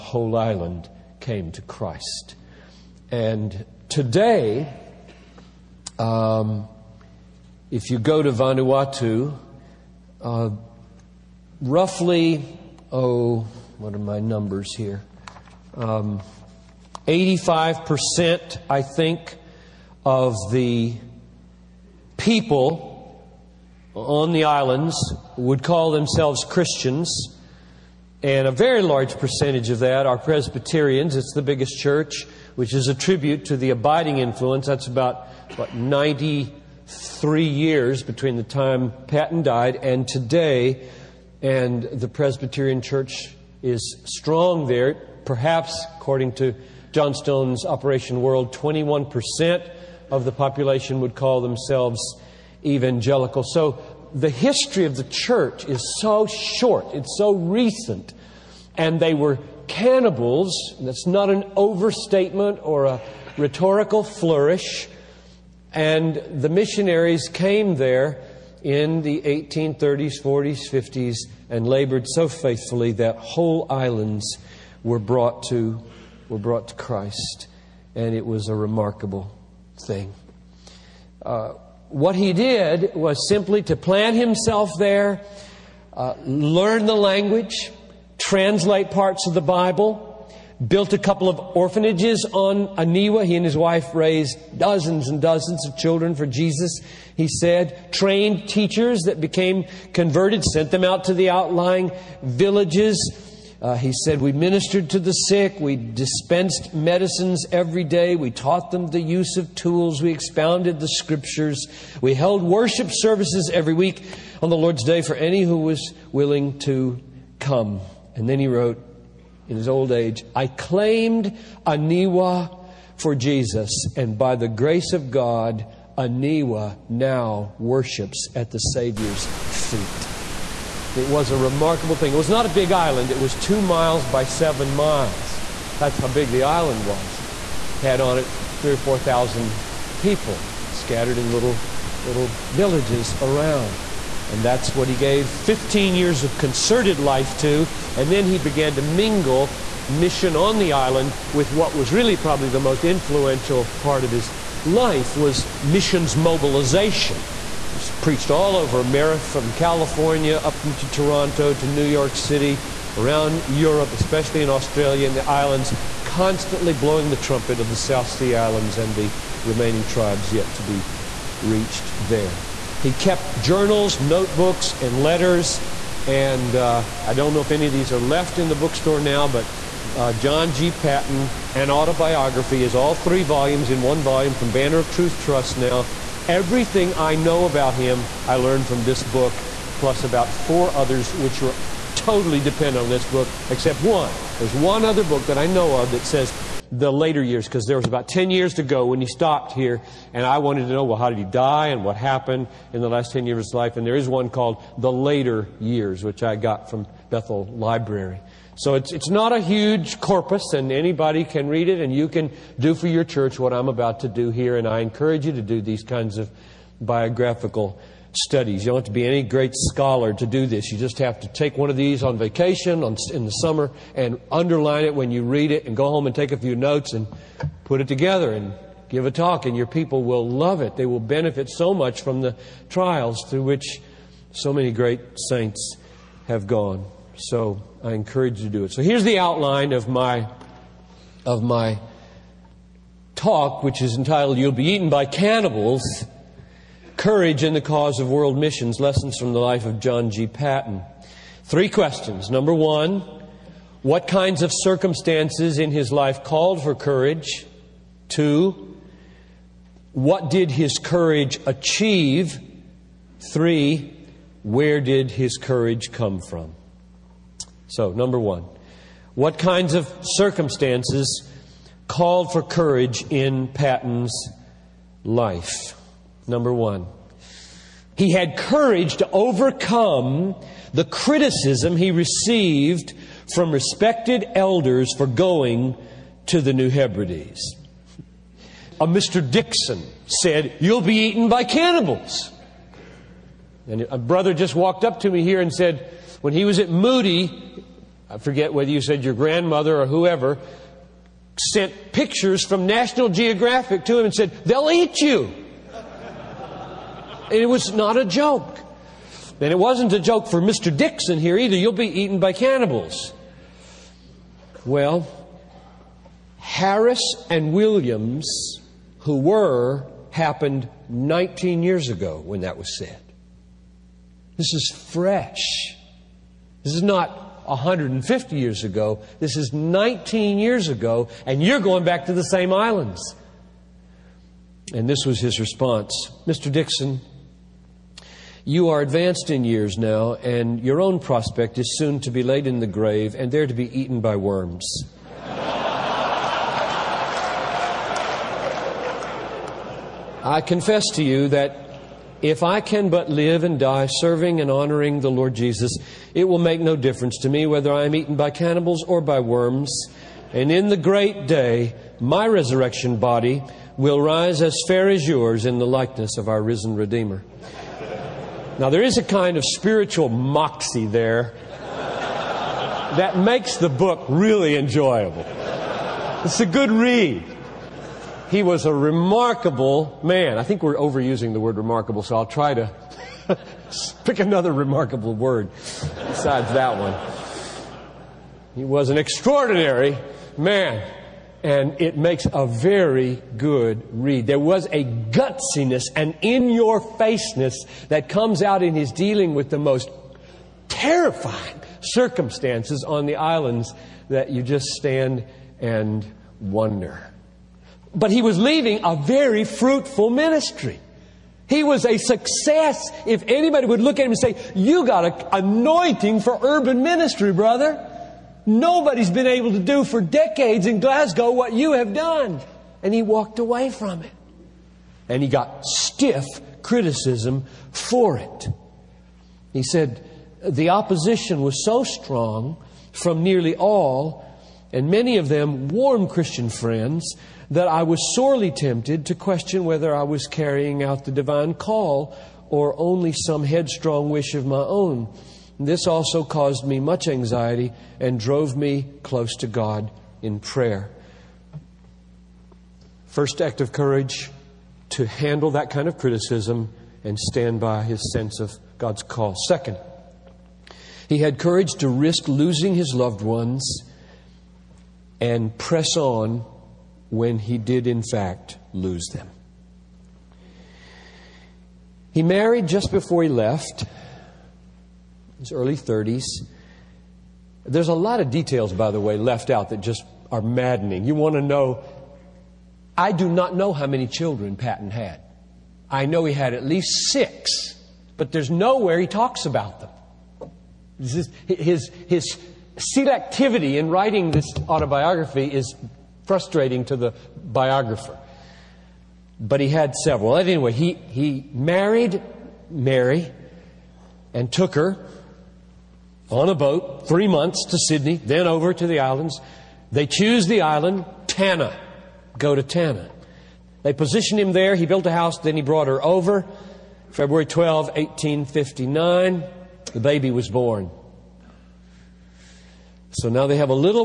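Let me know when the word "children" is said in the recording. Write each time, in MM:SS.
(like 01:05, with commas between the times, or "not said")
01:35, 08:04.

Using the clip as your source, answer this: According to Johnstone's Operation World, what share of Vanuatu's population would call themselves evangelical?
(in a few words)
21%.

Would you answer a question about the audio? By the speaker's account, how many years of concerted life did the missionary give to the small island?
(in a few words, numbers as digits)
15.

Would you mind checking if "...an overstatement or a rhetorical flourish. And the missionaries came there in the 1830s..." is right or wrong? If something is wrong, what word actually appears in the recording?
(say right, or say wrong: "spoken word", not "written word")
right.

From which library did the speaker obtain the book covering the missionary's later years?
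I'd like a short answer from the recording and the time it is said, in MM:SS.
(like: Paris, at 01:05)
Bethel Library, at 03:27.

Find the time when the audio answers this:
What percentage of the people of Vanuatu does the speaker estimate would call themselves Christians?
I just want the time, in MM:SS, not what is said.
00:17.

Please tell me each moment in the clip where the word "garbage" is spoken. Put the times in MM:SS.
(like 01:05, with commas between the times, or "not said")
not said.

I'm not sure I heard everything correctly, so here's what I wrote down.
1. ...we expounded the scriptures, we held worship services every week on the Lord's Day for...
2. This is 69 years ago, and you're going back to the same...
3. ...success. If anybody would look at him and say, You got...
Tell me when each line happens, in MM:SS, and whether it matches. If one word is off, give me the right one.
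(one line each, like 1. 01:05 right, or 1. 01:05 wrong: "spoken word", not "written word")
1. 01:50 right
2. 05:29 wrong: "19", not "69"
3. 06:51 right.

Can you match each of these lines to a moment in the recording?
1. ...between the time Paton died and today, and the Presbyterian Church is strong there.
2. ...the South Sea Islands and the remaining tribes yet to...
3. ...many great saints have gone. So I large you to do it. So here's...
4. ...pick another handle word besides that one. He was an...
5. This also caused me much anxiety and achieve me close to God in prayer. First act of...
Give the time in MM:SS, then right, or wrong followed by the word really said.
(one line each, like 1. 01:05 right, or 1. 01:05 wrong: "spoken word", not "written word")
1. 00:38 right
2. 02:47 right
3. 03:54 wrong: "encourage", not "large"
4. 06:24 wrong: "remarkable", not "handle"
5. 07:25 wrong: "drove", not "achieve".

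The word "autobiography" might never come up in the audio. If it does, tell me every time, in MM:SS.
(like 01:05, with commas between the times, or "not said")
03:01, 08:14.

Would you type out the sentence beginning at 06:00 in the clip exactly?
And in the great day, my resurrection body will rise as fair as yours in the likeness of our risen Redeemer.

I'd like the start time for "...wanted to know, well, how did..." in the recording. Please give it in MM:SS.
03:20.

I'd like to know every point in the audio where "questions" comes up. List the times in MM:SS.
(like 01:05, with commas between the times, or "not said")
04:11, 07:19.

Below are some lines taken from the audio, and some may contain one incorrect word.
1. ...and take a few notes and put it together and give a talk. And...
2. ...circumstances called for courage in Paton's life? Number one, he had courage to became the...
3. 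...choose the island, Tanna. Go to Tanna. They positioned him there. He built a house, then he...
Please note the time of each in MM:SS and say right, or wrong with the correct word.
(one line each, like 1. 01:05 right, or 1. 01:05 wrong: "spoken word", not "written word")
1. 03:46 right
2. 04:30 wrong: "overcome", not "became"
3. 08:30 right.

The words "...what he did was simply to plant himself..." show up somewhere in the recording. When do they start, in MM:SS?
01:21.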